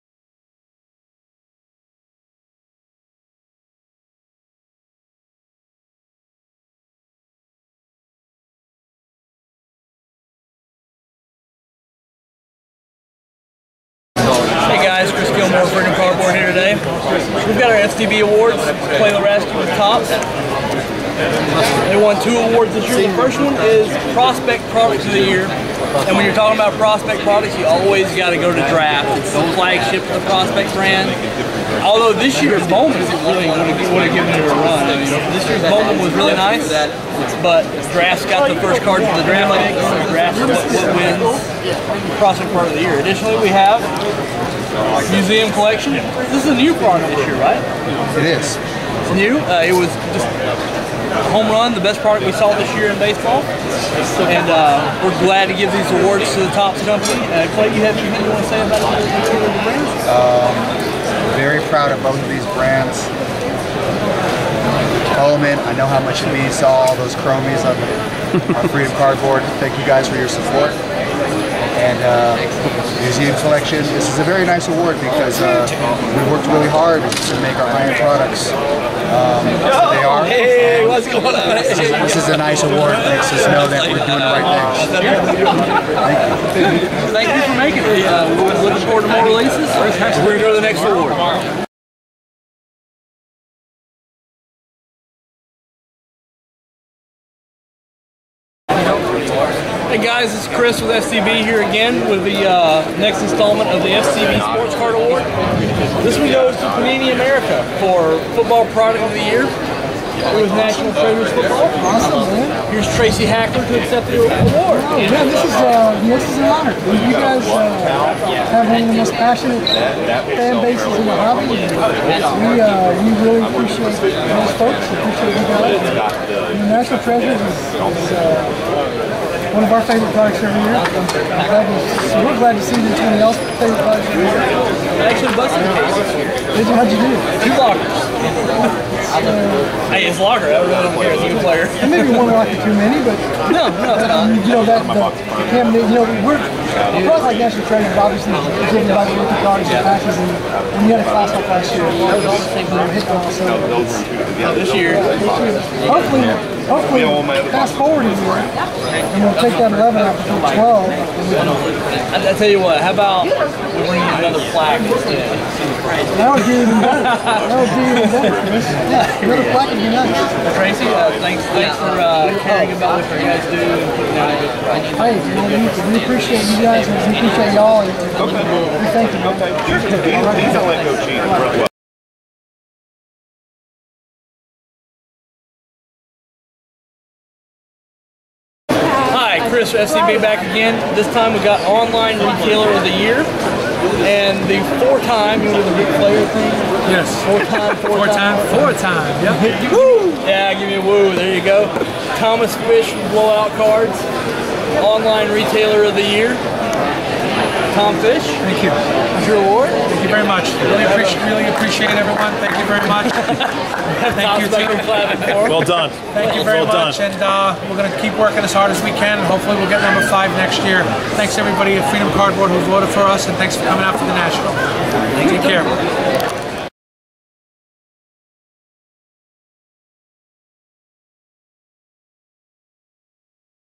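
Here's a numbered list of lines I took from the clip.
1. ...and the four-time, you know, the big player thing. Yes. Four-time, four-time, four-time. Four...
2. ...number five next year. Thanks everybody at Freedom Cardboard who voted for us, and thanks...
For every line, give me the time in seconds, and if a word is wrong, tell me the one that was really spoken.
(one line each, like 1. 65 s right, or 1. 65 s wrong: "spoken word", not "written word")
1. 194 s right
2. 219 s right.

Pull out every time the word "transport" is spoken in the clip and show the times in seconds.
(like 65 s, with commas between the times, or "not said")
not said.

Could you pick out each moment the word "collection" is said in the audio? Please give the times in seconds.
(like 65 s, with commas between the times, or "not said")
45 s, 73 s.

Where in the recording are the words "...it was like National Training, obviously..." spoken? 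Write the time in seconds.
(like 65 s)
146 s.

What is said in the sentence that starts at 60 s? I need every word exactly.
Um, proud of both of these brands.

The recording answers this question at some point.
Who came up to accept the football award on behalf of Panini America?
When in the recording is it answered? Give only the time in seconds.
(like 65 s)
112 s.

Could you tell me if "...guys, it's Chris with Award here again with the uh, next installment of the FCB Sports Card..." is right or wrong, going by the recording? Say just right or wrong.
wrong.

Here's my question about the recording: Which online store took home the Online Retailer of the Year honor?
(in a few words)
Blowout Cards.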